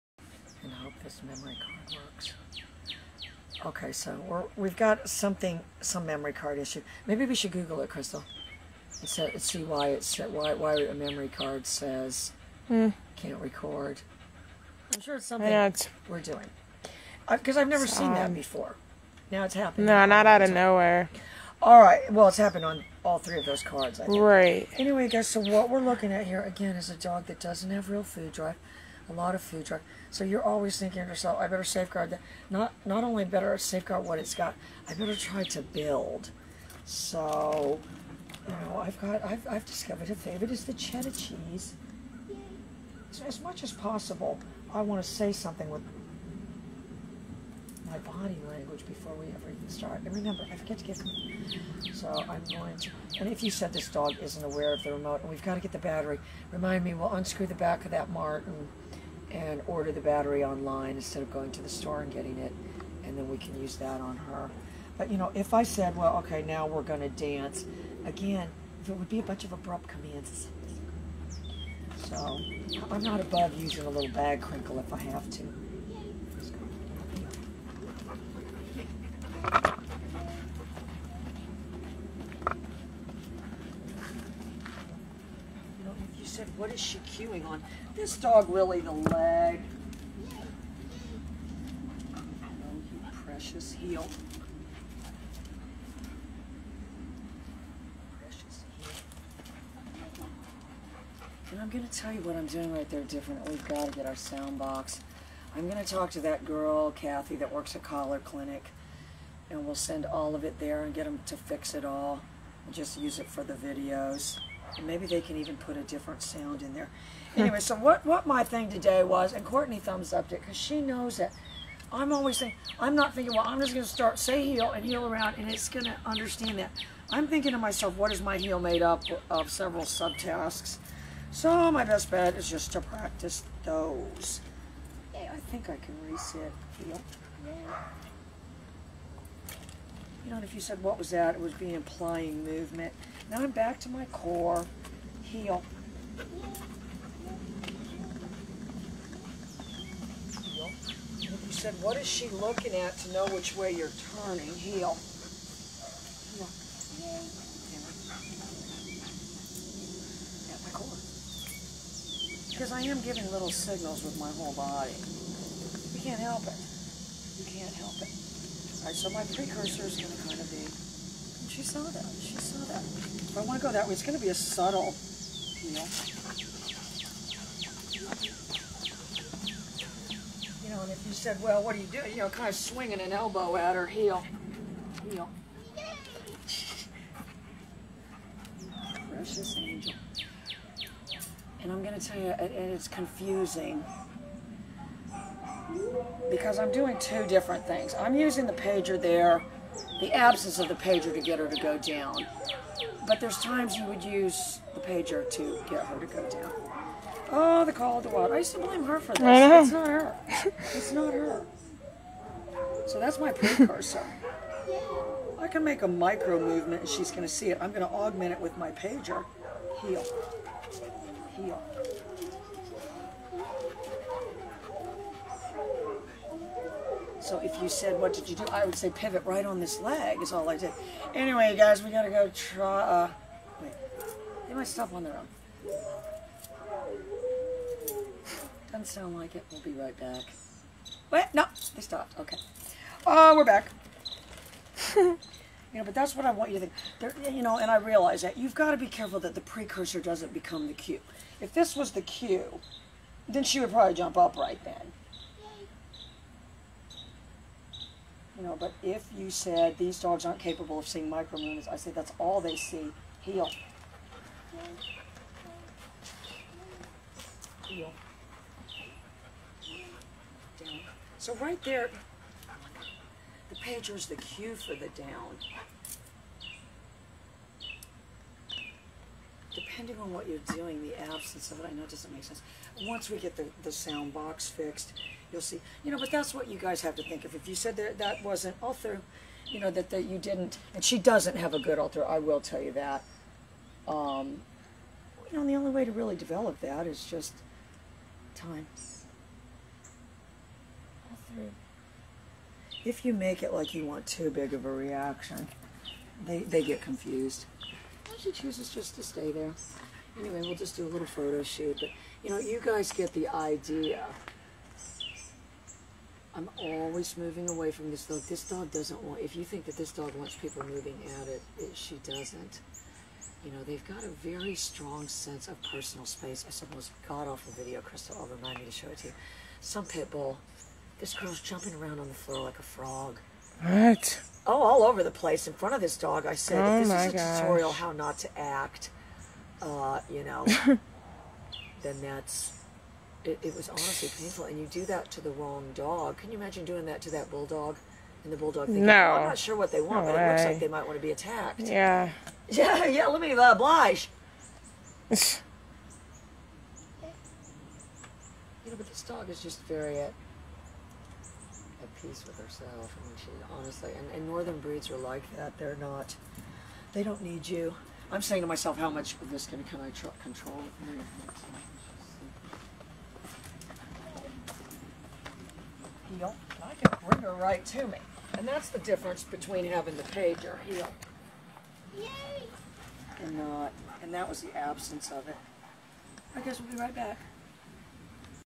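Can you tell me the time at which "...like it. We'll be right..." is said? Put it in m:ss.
3:59.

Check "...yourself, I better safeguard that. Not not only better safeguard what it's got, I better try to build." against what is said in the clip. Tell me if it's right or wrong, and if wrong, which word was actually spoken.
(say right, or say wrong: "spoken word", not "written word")
right.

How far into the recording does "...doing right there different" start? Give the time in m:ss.
1:42.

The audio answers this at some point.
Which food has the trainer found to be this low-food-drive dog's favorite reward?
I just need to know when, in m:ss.
0:40.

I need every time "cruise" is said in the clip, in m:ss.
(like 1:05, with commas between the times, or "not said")
not said.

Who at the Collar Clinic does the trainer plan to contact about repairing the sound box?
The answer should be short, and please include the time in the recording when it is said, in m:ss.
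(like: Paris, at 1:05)
Kathy, at 1:46.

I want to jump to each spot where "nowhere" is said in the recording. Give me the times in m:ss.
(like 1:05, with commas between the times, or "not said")
0:20.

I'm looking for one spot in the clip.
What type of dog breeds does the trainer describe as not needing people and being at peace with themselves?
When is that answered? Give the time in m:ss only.
6:04.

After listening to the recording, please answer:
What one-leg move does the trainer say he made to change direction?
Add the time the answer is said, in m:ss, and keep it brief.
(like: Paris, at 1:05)
Pivot right, at 3:48.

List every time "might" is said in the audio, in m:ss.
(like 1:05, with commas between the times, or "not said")
3:54, 5:50.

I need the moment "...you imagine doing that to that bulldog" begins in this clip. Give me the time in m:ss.
5:46.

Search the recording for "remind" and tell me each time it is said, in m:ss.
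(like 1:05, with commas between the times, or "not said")
0:56, 5:28.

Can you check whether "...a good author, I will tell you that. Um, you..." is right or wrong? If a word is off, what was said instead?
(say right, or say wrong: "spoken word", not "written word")
right.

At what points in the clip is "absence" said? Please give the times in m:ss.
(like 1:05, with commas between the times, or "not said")
3:20, 4:41, 6:24.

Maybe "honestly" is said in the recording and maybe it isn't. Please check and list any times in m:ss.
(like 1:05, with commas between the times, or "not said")
5:43, 6:03.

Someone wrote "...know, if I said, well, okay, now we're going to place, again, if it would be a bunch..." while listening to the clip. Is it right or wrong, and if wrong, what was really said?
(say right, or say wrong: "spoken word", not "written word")
wrong: "dance", not "place".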